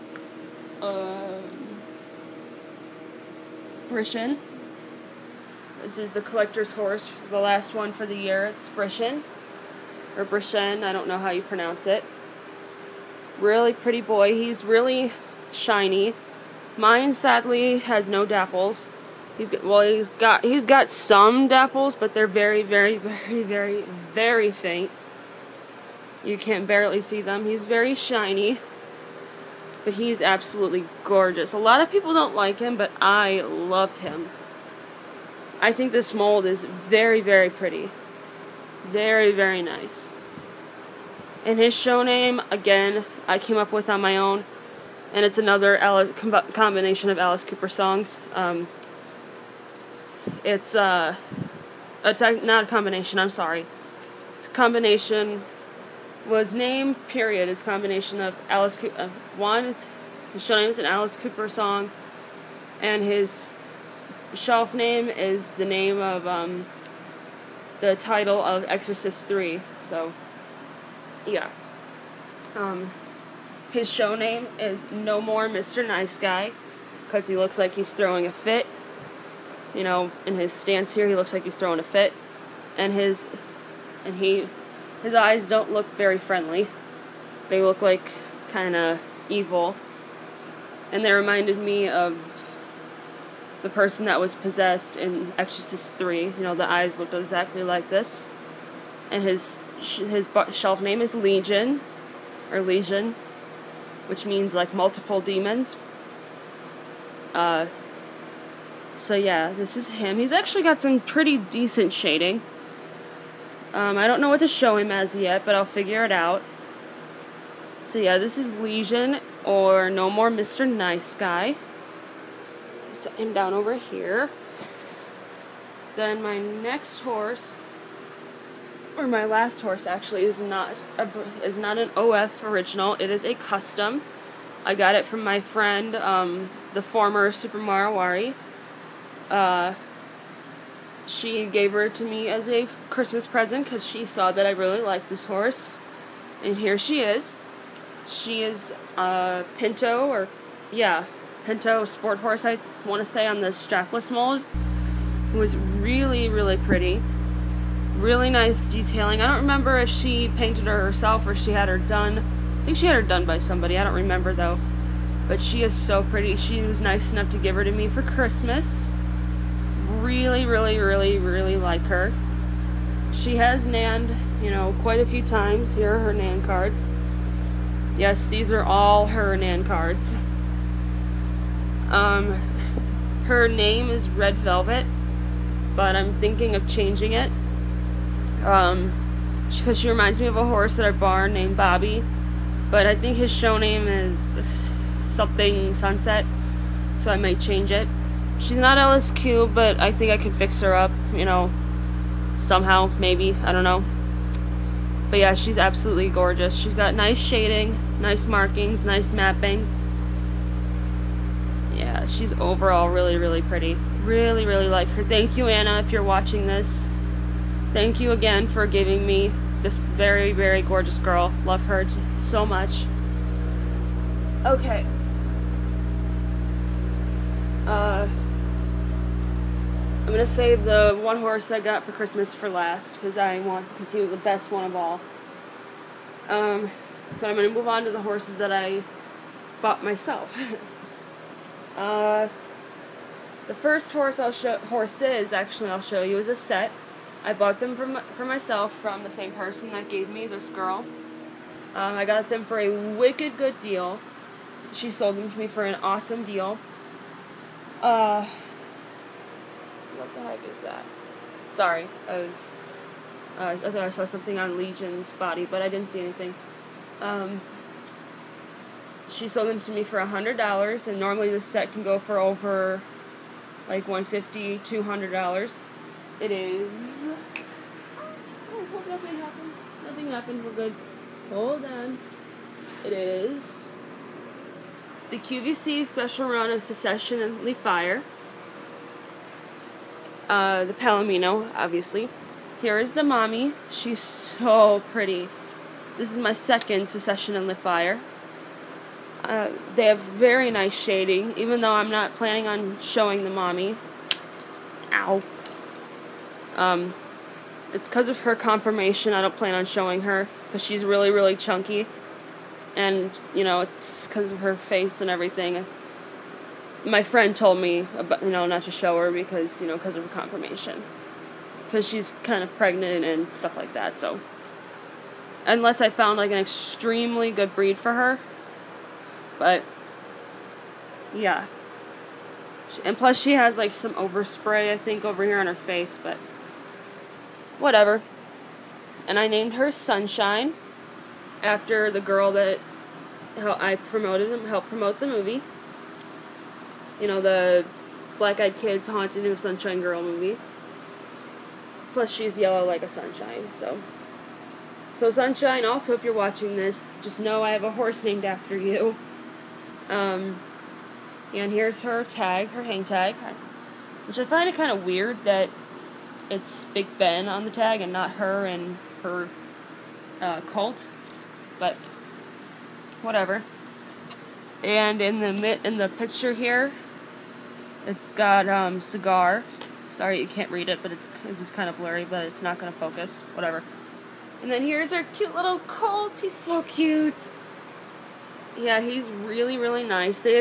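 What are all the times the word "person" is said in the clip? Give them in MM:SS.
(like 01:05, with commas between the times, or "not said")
01:33, 04:09.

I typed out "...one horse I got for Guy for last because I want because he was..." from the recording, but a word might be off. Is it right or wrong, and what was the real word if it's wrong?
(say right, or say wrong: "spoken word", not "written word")
wrong: "Christmas", not "Guy".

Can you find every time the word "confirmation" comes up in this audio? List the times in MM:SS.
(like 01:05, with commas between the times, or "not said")
05:08, 05:20.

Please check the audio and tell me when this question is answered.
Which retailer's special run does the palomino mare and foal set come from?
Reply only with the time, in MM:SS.
04:45.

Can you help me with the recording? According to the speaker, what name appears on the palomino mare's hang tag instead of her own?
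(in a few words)
Big Ben.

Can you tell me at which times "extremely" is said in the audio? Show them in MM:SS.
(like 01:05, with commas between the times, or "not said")
05:26.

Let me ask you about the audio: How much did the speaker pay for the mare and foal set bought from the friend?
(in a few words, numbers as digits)
$100.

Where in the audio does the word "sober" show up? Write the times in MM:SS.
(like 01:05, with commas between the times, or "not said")
not said.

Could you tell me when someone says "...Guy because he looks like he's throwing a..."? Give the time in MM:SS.
01:16.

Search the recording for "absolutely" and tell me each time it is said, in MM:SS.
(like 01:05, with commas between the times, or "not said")
00:30, 03:25.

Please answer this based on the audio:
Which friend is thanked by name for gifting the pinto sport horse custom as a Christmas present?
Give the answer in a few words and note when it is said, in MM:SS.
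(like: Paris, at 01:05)
Anna, at 03:35.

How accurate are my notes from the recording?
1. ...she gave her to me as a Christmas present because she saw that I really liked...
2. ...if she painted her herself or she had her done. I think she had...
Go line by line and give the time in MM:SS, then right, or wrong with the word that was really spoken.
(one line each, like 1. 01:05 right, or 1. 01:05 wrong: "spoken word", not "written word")
1. 02:21 right
2. 02:39 right.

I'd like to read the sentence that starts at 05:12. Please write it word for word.
And, you know, it's because of her face and everything.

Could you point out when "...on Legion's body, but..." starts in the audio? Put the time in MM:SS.
04:24.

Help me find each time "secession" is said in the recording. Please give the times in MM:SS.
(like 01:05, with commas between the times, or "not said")
04:46, 04:56.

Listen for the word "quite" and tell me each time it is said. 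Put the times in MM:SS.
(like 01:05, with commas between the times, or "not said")
02:54.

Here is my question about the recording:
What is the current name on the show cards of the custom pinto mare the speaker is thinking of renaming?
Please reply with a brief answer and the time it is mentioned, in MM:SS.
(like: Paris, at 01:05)
Red Velvet, at 03:04.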